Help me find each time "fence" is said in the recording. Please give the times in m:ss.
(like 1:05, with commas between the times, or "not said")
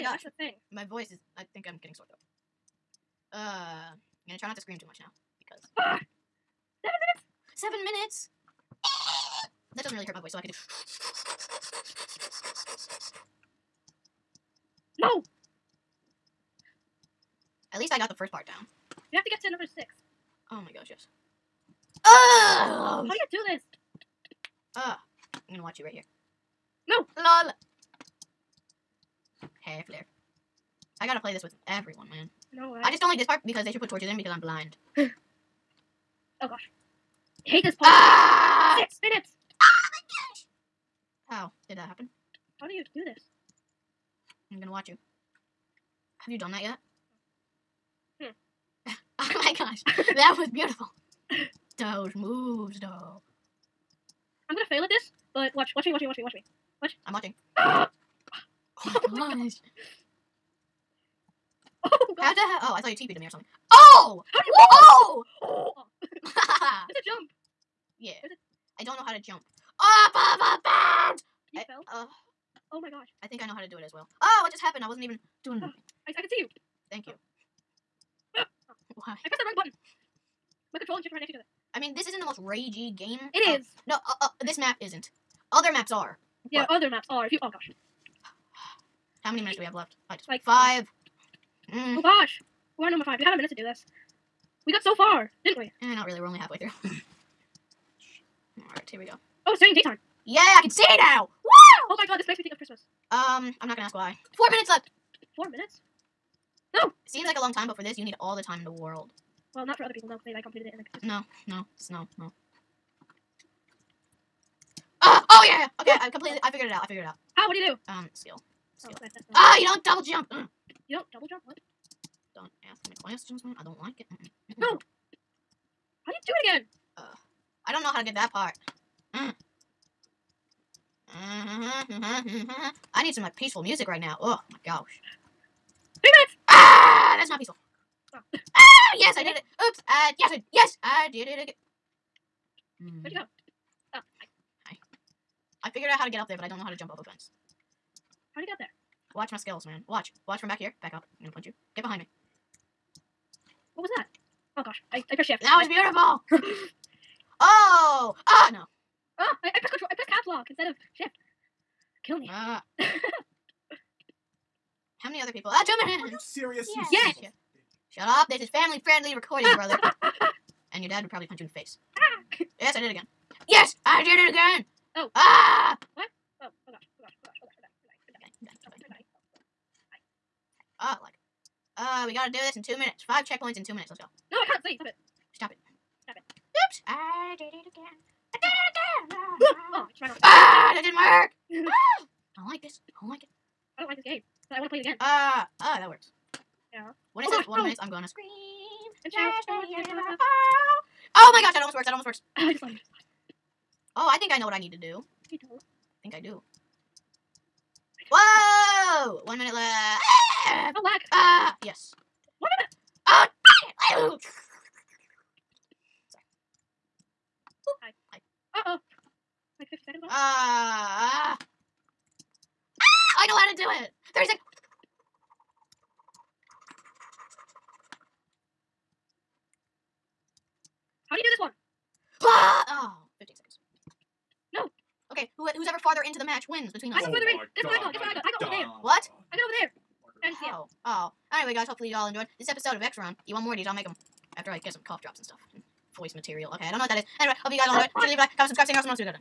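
2:27.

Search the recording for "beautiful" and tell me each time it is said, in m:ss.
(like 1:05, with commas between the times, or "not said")
0:50, 2:36.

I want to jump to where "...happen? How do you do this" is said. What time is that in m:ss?
0:41.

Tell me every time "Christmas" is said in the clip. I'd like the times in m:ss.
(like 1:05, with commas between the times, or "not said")
1:42.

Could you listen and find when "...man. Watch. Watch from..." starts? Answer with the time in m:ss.
2:29.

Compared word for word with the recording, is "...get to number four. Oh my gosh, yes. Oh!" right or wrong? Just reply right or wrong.
wrong.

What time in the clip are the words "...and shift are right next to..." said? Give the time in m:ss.
1:20.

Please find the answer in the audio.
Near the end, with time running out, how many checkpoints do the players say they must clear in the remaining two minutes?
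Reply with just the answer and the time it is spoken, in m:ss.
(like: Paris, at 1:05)
5, at 3:03.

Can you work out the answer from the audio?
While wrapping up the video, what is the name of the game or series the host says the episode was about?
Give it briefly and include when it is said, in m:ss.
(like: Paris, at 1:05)
X Run, at 4:02.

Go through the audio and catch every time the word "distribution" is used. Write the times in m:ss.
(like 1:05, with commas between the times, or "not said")
not said.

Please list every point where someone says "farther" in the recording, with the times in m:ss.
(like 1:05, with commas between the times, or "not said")
3:55.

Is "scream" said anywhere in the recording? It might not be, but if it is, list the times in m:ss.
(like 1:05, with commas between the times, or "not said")
0:04, 3:18.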